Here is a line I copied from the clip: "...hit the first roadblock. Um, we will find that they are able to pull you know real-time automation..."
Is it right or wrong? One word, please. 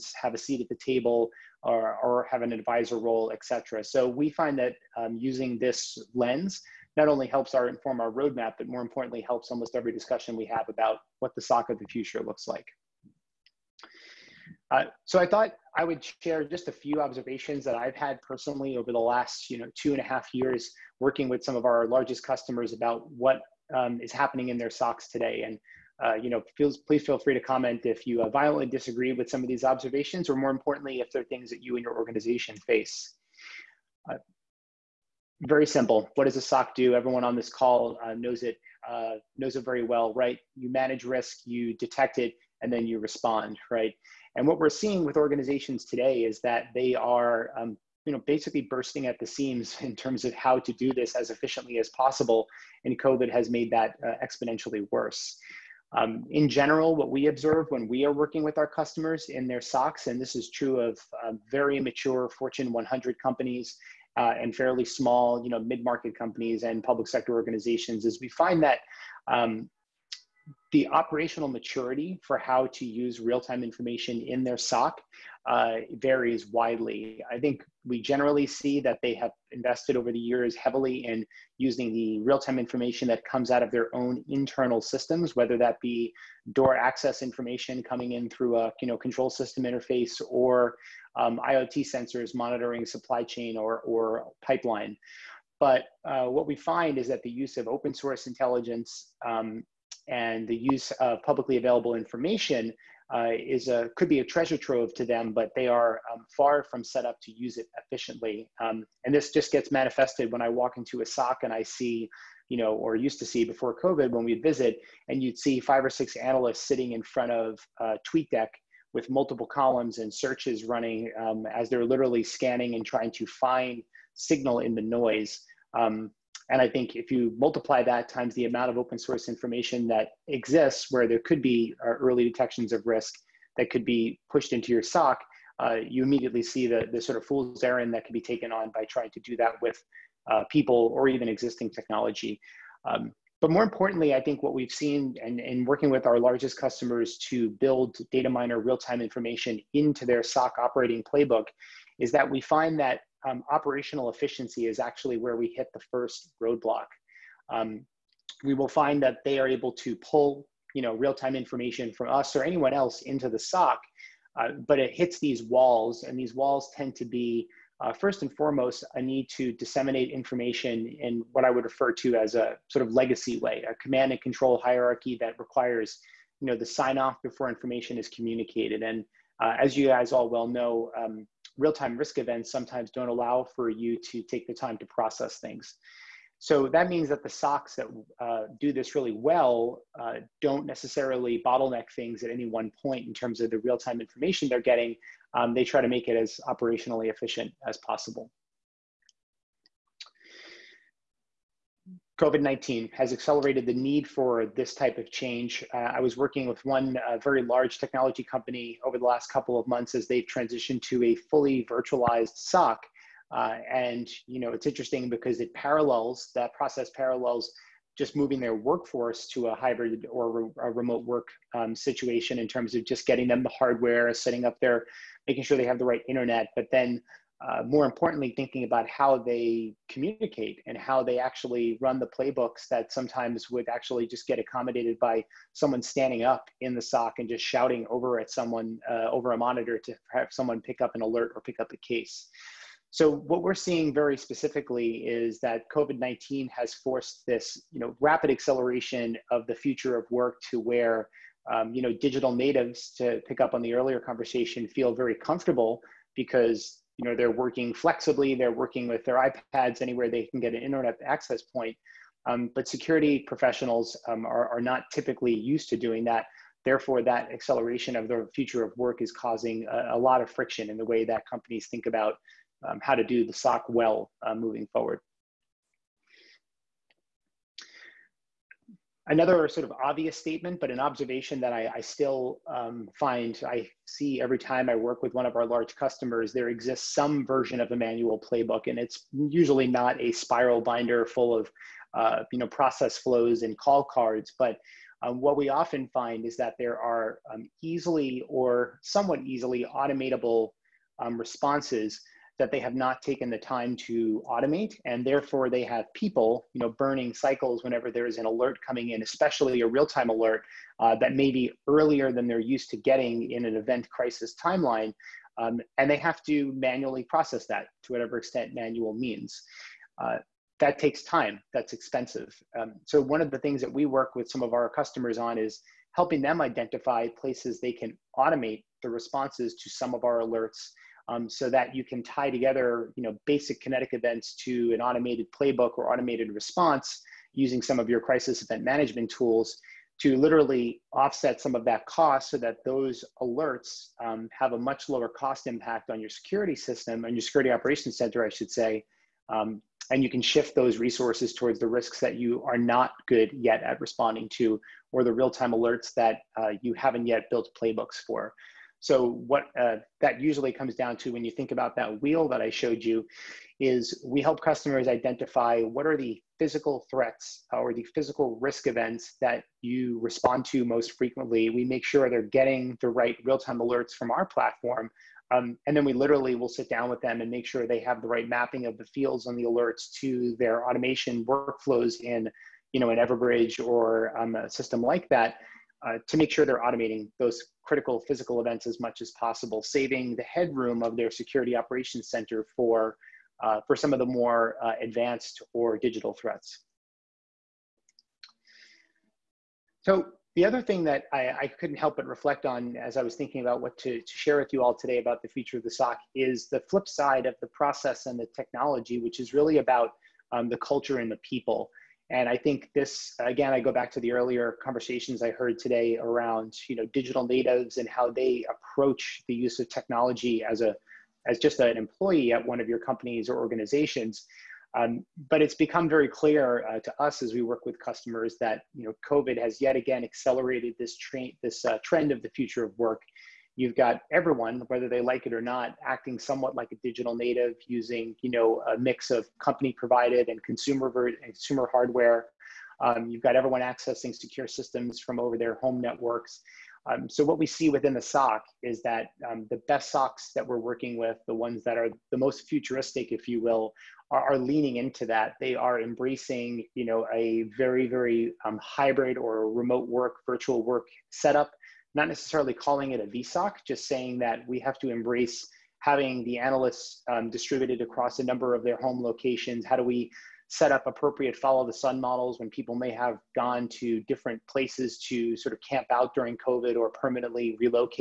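wrong.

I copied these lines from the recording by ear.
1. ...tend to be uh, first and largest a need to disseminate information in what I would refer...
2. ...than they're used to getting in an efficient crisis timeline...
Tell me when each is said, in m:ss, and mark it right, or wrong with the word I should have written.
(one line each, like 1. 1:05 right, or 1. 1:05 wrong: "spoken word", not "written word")
1. 2:46 wrong: "foremost", not "largest"
2. 5:12 wrong: "event", not "efficient".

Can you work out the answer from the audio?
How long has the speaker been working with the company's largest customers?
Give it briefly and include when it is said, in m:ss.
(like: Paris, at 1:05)
2.5 years, at 0:19.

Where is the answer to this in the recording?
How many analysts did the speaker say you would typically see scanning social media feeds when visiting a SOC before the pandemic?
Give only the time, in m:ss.
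1:55.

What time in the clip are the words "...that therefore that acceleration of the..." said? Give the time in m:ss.
4:26.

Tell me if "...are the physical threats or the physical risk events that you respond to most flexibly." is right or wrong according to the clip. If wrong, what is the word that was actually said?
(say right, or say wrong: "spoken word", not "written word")
wrong: "frequently", not "flexibly".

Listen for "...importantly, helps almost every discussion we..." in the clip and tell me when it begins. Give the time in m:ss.
0:08.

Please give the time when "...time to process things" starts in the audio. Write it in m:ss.
3:04.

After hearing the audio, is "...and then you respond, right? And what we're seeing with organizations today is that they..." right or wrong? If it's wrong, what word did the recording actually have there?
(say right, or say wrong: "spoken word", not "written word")
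right.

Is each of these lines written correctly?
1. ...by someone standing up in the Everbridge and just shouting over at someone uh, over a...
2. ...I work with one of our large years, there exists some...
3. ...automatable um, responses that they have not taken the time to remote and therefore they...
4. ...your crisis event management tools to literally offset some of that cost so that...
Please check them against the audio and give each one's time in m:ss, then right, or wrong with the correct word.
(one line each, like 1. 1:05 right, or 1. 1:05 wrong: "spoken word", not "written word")
1. 3:54 wrong: "SOC", not "Everbridge"
2. 4:44 wrong: "customers", not "years"
3. 4:59 wrong: "automate", not "remote"
4. 5:37 right.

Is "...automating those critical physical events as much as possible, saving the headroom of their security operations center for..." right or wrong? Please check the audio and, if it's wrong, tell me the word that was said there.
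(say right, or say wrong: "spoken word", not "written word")
right.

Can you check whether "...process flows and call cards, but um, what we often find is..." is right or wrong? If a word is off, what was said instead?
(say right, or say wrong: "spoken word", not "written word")
right.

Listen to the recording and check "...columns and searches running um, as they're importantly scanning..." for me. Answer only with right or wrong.
wrong.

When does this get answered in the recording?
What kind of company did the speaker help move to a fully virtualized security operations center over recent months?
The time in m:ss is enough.
3:27.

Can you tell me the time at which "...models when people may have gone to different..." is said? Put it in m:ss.
7:51.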